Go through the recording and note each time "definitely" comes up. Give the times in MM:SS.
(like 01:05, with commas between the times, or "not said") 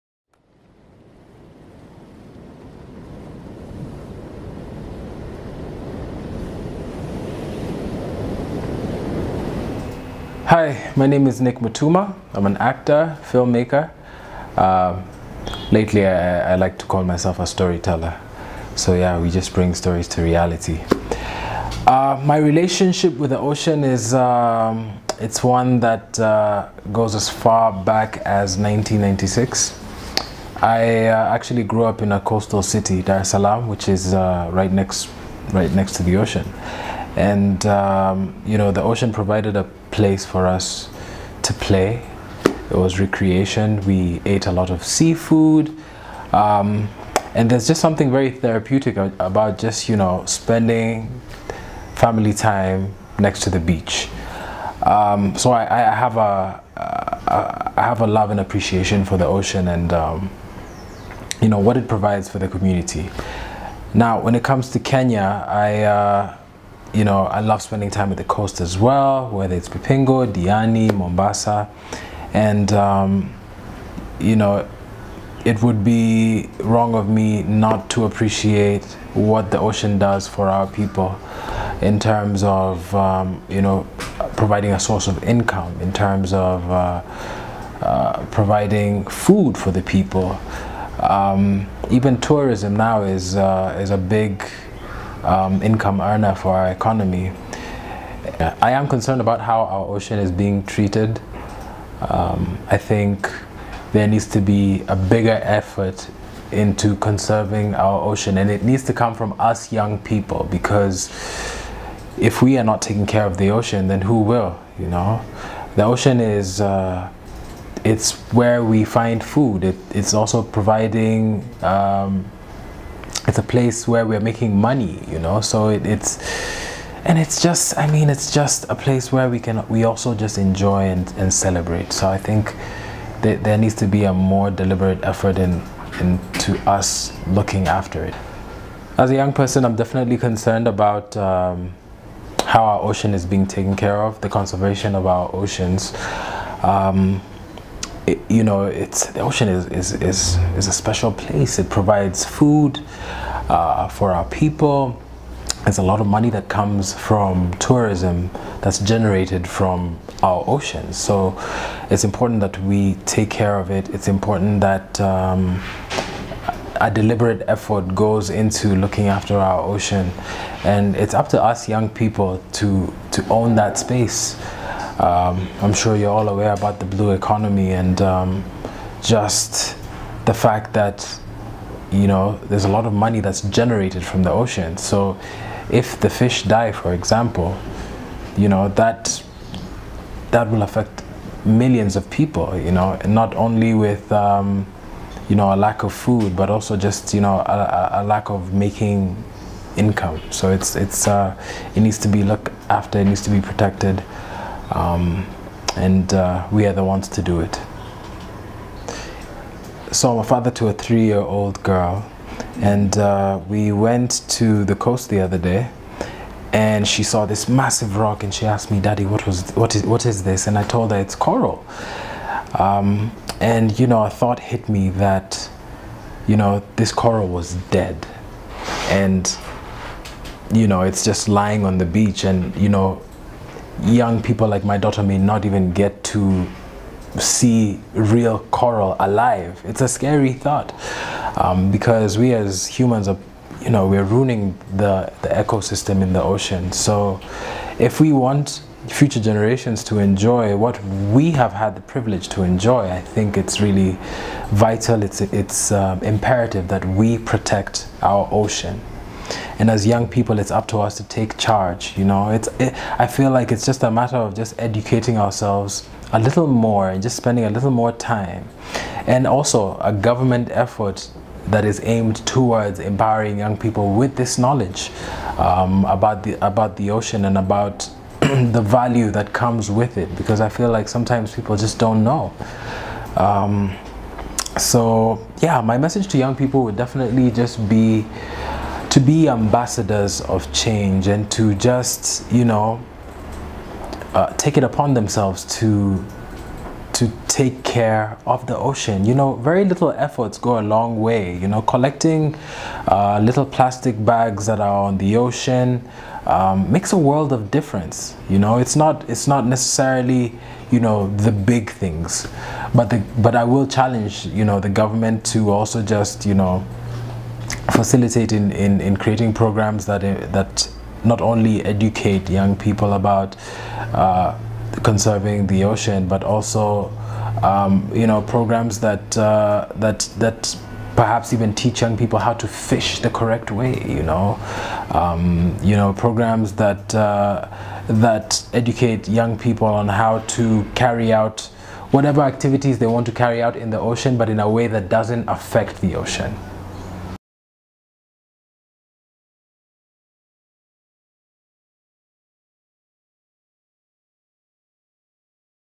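02:19, 04:46.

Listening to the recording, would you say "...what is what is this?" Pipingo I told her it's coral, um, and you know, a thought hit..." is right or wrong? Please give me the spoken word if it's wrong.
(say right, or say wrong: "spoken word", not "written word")
wrong: "And", not "Pipingo".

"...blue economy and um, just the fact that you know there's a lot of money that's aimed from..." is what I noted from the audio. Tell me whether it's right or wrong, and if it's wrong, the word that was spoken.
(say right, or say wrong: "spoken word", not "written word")
wrong: "generated", not "aimed".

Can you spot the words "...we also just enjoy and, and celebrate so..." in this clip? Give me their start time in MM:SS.
02:09.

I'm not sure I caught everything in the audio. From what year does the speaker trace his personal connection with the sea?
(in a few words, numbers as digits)
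1996.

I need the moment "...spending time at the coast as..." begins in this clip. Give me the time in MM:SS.
01:07.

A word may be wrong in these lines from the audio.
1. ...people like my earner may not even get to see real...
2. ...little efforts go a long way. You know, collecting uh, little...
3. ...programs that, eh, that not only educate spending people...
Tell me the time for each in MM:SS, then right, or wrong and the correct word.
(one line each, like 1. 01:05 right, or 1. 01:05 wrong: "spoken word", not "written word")
1. 03:54 wrong: "daughter", not "earner"
2. 04:59 right
3. 05:19 wrong: "young", not "spending".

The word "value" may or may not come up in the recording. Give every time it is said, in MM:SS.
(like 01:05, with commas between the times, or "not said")
04:38.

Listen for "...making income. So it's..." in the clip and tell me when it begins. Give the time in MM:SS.
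03:18.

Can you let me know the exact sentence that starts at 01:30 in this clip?
Um, even tourism now is, uh, is a big um, income earner for our economy.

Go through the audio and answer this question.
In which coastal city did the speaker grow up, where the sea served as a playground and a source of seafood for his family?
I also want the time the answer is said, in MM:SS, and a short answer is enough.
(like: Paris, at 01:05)
Dar es Salaam, at 00:33.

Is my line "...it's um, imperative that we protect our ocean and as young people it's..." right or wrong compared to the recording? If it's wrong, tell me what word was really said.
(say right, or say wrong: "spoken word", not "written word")
right.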